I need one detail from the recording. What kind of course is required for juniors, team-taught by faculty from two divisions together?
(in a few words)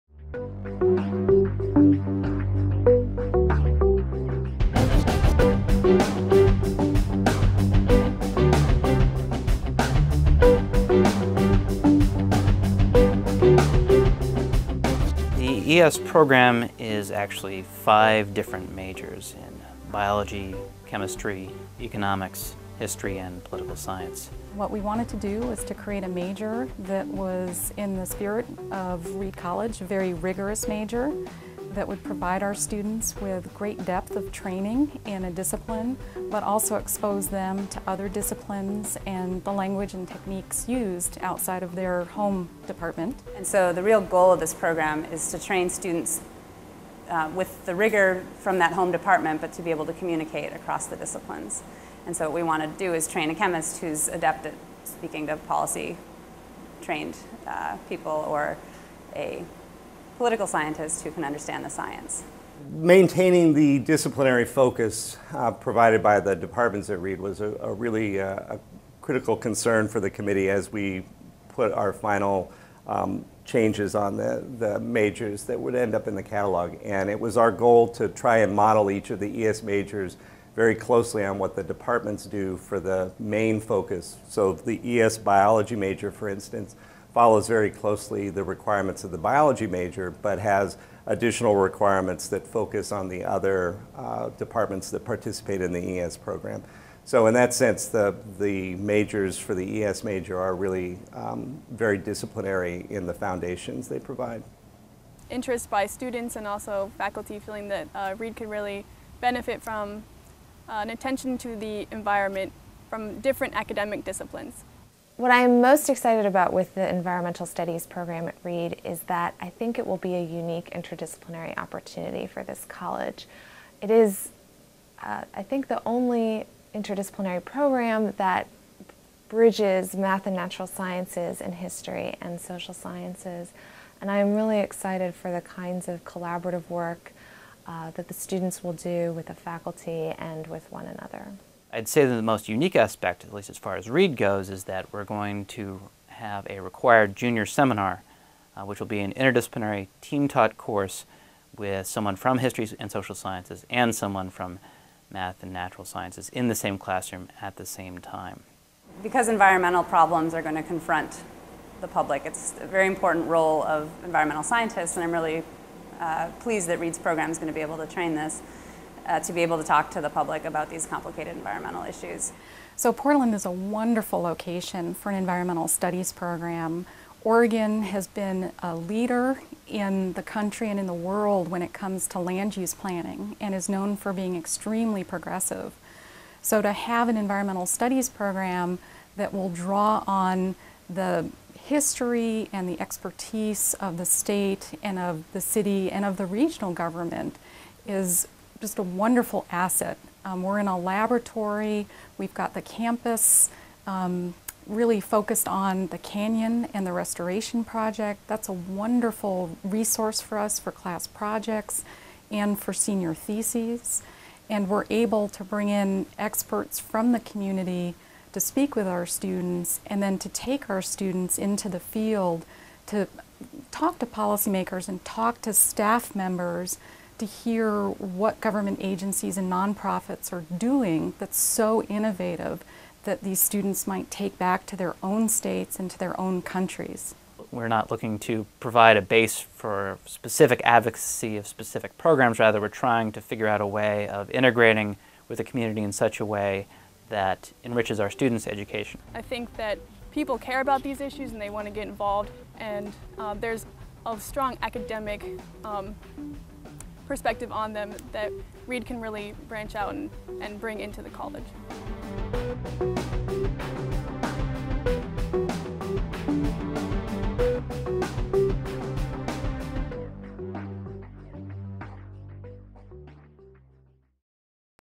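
Junior seminar.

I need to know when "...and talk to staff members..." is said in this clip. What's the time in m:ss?
3:44.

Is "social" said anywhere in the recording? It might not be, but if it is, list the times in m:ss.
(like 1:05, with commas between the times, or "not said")
2:12, 2:32.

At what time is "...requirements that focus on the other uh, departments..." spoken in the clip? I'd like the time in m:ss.
1:31.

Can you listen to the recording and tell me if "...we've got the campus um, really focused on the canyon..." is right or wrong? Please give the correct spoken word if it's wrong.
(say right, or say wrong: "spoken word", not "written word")
right.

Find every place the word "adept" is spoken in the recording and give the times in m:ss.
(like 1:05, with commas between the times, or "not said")
0:54.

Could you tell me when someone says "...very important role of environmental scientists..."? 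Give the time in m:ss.
2:42.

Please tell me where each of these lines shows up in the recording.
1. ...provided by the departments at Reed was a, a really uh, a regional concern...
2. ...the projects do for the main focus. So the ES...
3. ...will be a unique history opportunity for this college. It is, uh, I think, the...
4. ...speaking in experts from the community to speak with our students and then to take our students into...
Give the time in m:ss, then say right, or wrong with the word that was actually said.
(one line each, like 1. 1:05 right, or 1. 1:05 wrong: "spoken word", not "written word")
1. 1:05 wrong: "critical", not "regional"
2. 1:21 wrong: "departments", not "projects"
3. 1:59 wrong: "interdisciplinary", not "history"
4. 3:35 wrong: "bring", not "speaking".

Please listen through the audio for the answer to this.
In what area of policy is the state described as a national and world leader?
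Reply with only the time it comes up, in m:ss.
3:02.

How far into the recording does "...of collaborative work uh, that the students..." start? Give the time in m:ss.
2:15.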